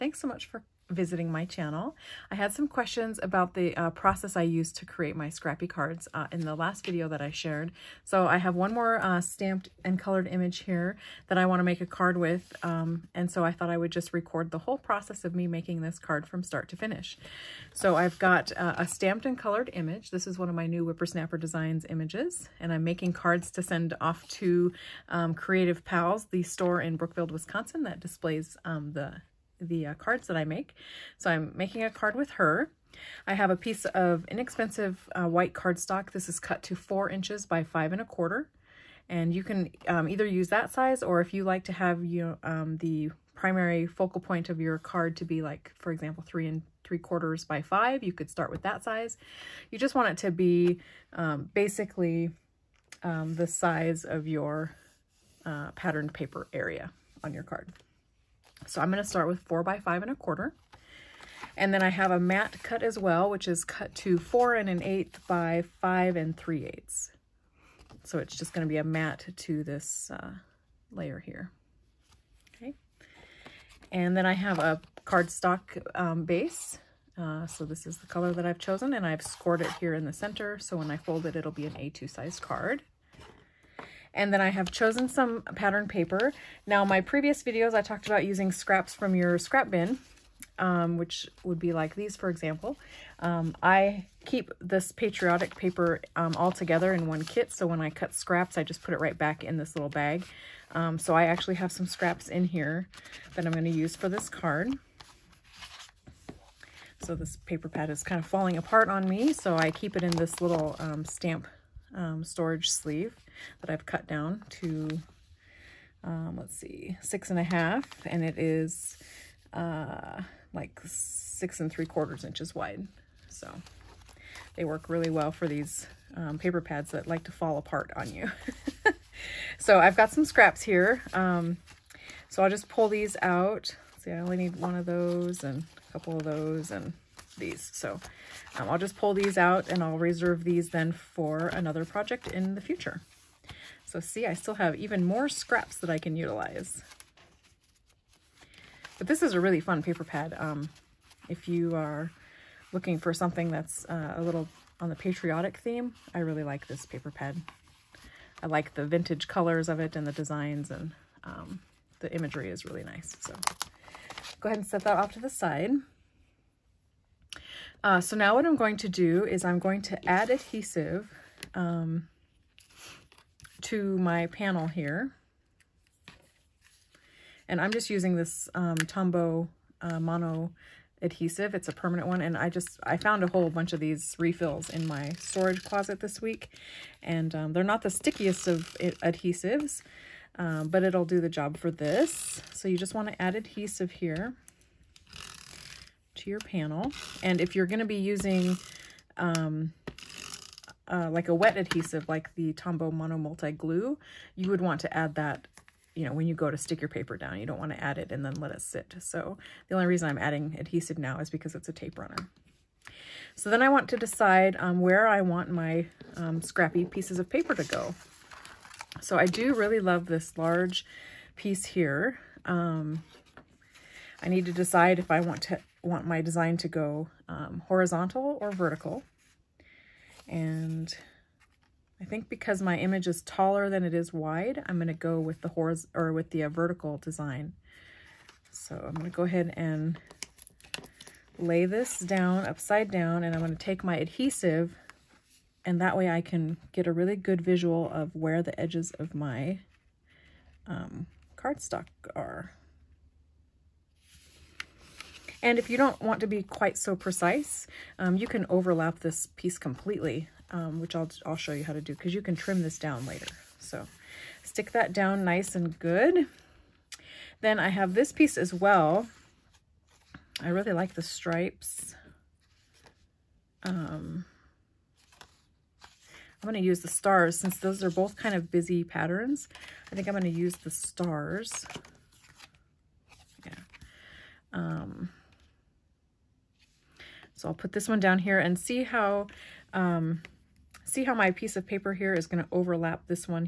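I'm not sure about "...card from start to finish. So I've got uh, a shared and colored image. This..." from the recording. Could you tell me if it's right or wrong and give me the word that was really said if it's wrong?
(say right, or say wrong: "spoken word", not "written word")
wrong: "stamped", not "shared".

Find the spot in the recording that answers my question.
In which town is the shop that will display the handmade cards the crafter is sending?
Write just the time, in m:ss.
0:26.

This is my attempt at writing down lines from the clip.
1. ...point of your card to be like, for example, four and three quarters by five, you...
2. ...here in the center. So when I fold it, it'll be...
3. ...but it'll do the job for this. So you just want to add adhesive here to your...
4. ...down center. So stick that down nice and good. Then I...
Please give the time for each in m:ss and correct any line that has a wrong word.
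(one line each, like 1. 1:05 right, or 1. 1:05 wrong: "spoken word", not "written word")
1. 0:44 wrong: "three", not "four"
2. 1:19 right
3. 3:10 right
4. 4:22 wrong: "later", not "center".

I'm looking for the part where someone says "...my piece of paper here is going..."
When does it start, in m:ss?
4:51.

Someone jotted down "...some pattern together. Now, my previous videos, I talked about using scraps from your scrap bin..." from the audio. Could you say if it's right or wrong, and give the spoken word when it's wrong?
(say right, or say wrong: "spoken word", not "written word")
wrong: "paper", not "together".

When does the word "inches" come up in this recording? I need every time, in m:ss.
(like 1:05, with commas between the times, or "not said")
0:37, 2:02.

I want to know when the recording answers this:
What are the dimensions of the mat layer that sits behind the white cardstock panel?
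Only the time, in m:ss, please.
1:04.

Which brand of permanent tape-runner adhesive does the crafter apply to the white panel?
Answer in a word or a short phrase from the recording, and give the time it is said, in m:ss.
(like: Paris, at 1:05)
Tombow Mono, at 2:58.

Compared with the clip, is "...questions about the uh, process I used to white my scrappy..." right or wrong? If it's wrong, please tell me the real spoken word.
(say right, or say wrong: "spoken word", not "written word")
wrong: "create", not "white".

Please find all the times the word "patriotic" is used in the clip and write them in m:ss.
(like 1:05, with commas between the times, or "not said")
1:34, 2:34.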